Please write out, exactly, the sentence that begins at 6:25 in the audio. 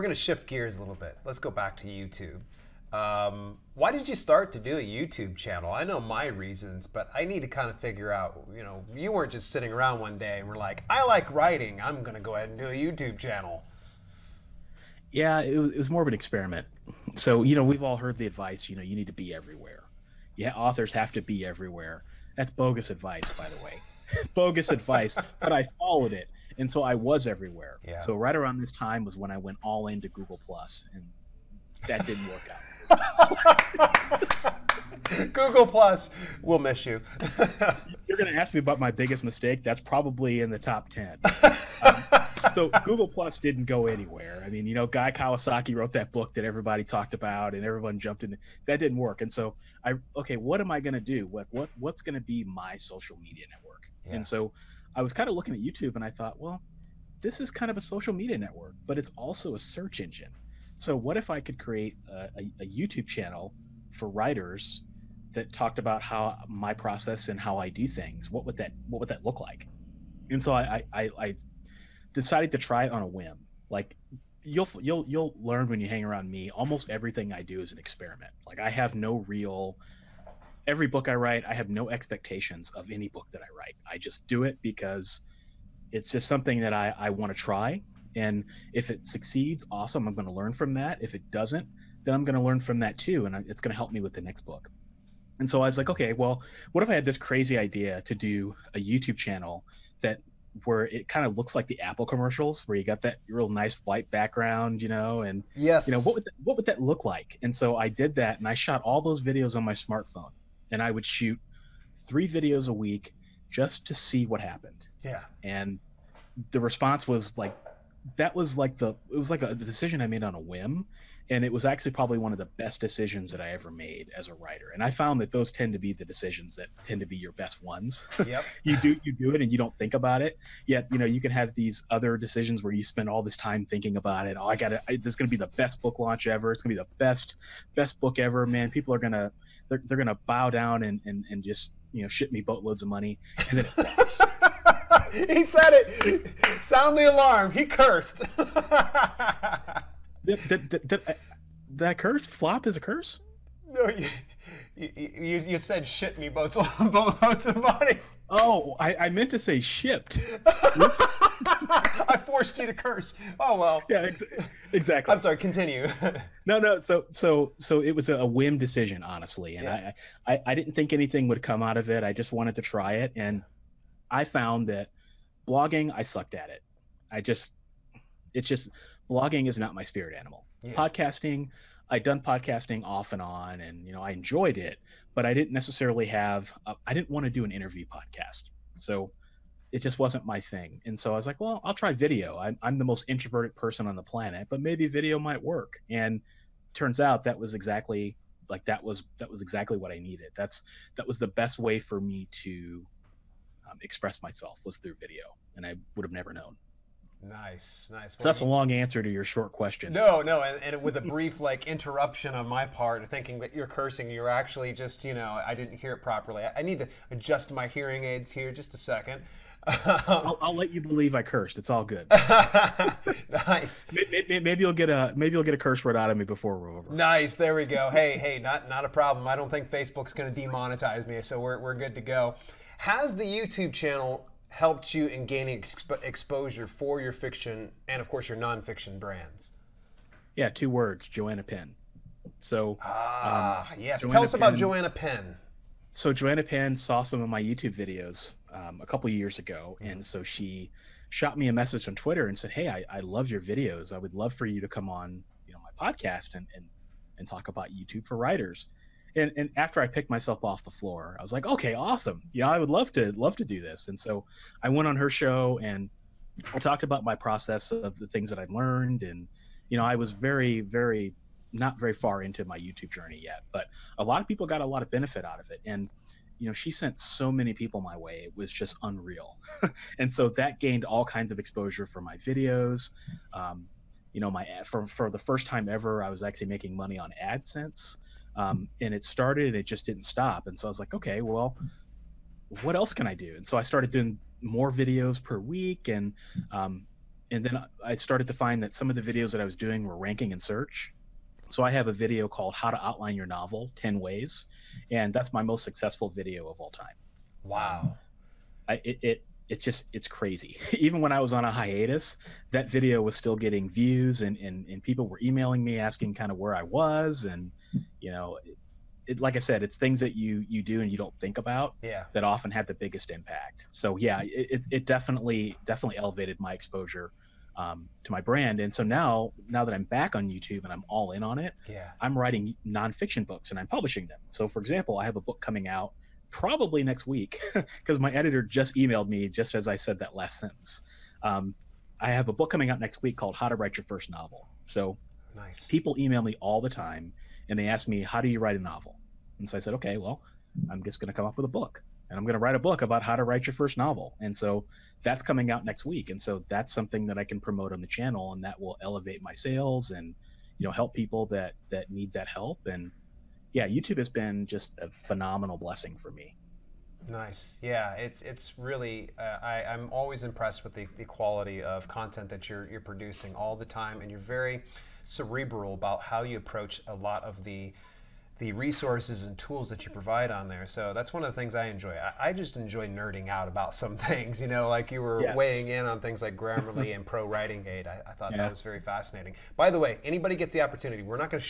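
weighing in on things like Grammarly and Pro Writing Aid.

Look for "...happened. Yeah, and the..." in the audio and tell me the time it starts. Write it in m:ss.
1:54.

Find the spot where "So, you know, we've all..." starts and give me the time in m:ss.
0:17.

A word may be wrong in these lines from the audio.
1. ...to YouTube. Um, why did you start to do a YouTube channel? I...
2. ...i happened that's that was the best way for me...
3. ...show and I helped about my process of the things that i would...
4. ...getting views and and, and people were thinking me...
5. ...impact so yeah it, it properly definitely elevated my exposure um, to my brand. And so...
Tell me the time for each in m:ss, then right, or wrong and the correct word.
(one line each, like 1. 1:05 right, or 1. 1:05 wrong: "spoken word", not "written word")
1. 0:01 right
2. 3:19 wrong: "needed", not "happened"
3. 4:25 wrong: "talked", not "helped"
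4. 5:13 wrong: "emailing", not "thinking"
5. 5:23 wrong: "definitely", not "properly".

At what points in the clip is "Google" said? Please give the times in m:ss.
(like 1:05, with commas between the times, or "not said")
0:30, 0:35, 0:42.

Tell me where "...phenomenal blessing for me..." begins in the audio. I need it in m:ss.
6:04.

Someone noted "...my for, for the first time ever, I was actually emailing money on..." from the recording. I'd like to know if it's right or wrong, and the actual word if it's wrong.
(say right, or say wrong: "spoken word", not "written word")
wrong: "making", not "emailing".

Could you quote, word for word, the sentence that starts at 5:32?
I'm writing nonfiction books and I'm publishing them.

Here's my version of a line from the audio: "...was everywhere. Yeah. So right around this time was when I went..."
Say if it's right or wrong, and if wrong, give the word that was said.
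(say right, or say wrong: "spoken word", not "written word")
right.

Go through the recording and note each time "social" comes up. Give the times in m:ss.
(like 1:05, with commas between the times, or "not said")
0:52, 0:57.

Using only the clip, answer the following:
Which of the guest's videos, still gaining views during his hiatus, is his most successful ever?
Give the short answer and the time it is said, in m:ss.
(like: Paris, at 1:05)
How to Outline Your Novel 10 Ways, at 5:02.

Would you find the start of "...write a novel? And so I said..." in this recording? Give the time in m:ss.
5:48.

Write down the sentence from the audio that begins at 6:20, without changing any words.
So that's one of the things I enjoy.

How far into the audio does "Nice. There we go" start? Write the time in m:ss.
3:46.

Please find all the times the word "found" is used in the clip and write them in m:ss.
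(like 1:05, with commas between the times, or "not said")
2:04, 2:54.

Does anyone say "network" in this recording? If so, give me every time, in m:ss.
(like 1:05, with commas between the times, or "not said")
0:53, 0:58.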